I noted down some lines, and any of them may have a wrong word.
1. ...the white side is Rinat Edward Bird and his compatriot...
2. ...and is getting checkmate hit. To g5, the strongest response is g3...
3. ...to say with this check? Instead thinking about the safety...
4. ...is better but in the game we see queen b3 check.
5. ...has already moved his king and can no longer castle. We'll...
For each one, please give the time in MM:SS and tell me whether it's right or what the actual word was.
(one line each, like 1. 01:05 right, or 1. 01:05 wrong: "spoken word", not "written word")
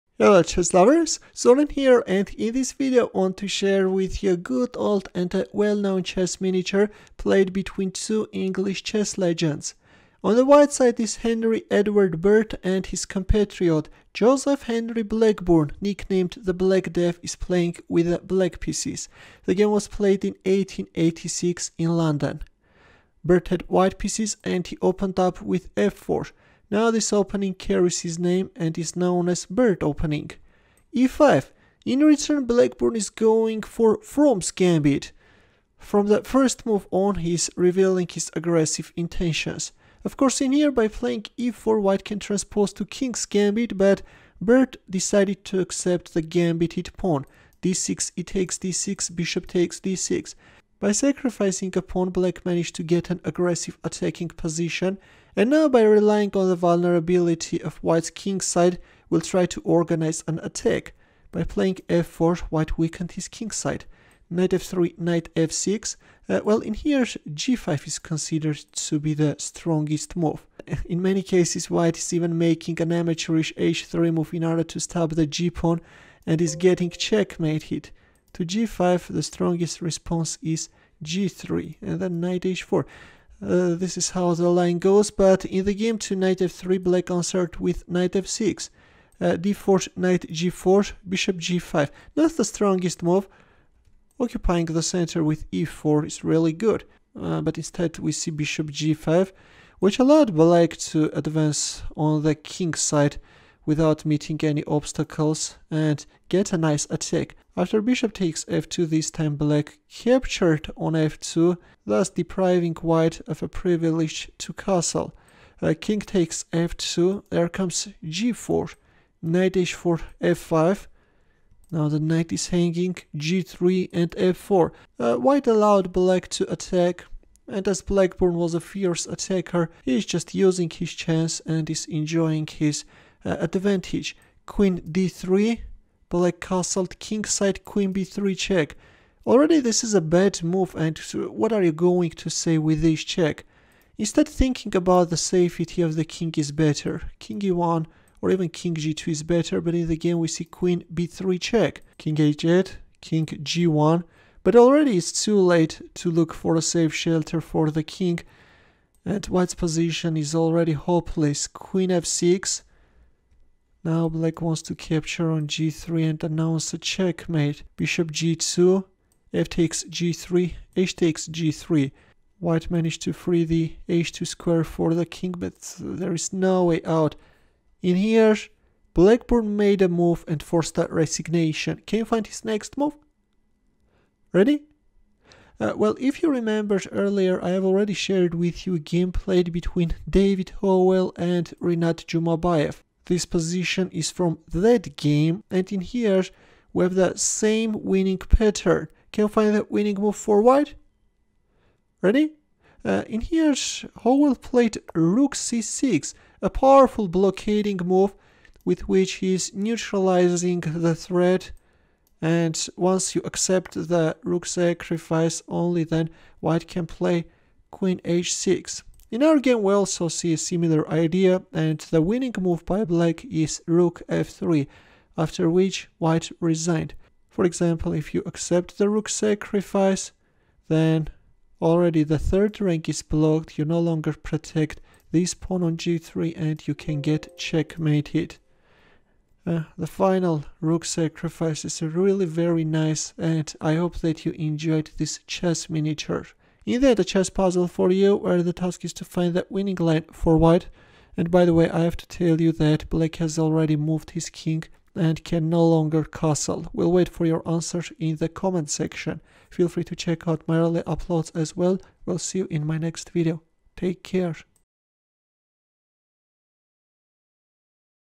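1. 00:10 wrong: "Henry", not "Rinat"
2. 01:16 right
3. 02:22 right
4. 02:29 right
5. 04:13 right.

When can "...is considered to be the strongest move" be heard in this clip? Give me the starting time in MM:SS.
01:07.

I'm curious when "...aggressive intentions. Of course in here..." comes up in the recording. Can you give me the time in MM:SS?
00:38.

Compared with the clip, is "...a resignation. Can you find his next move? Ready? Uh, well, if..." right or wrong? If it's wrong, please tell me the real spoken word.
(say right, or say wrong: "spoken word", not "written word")
right.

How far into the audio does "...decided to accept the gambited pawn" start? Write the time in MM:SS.
00:44.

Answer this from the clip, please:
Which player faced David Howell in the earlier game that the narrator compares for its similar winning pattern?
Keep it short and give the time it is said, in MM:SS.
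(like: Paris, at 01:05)
Rinat Jumabayev, at 03:11.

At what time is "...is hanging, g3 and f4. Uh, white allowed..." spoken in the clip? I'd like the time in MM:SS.
02:02.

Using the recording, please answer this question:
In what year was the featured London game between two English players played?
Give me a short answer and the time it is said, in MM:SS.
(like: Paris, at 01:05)
1886, at 00:20.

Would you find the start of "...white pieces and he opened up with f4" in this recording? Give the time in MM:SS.
00:23.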